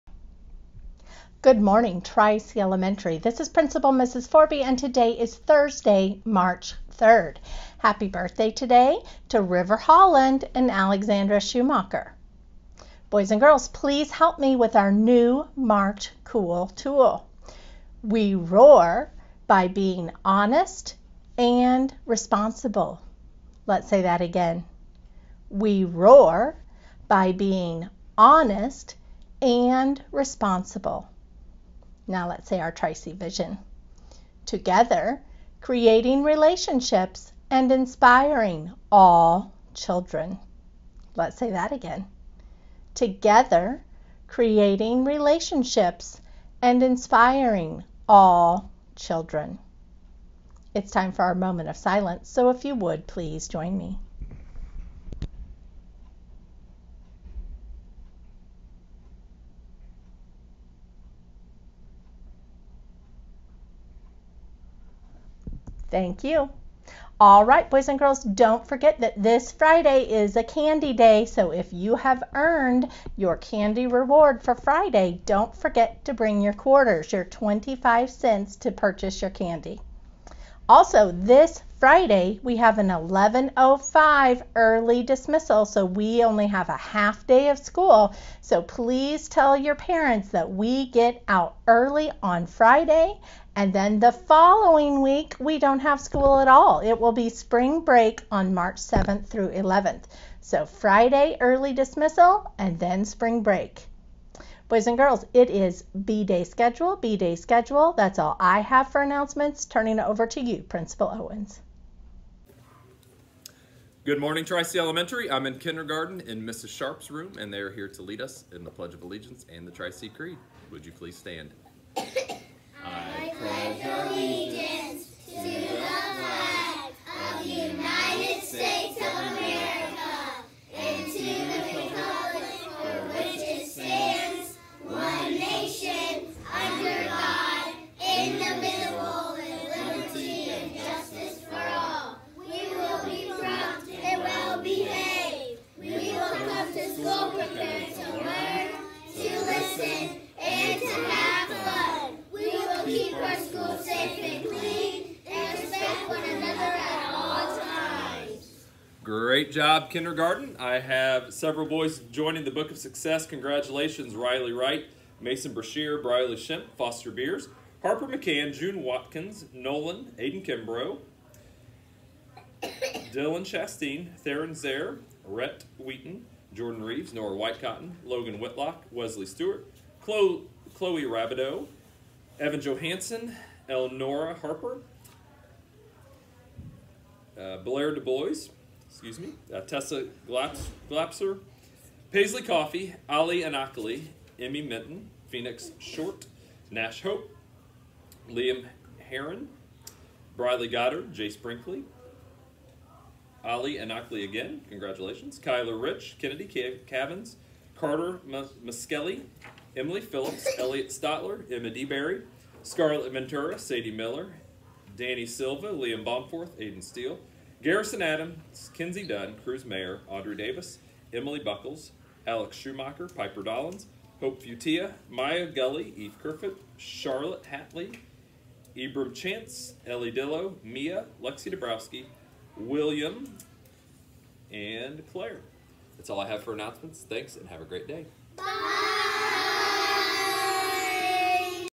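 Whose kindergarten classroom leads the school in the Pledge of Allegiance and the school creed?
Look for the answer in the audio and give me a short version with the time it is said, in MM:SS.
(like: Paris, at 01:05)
Mrs. Sharp's, at 01:56.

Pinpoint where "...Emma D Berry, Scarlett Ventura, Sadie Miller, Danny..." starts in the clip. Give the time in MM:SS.
03:31.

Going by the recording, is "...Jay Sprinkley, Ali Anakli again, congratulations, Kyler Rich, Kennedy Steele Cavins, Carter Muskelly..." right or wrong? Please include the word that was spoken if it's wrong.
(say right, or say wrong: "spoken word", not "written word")
wrong: "Cav", not "Steele".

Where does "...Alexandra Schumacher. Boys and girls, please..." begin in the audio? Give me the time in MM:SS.
00:10.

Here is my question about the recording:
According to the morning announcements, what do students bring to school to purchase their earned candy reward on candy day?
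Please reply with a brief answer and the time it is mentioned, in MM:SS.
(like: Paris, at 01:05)
quarters, at 01:16.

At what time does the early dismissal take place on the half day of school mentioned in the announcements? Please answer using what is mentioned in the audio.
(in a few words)
11:05.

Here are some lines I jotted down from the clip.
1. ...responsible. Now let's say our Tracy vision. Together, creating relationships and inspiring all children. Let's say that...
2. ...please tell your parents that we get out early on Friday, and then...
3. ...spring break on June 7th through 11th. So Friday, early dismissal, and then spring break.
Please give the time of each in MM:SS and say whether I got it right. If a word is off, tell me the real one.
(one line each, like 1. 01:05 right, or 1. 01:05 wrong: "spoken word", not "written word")
1. 00:30 right
2. 01:28 right
3. 01:37 wrong: "March", not "June".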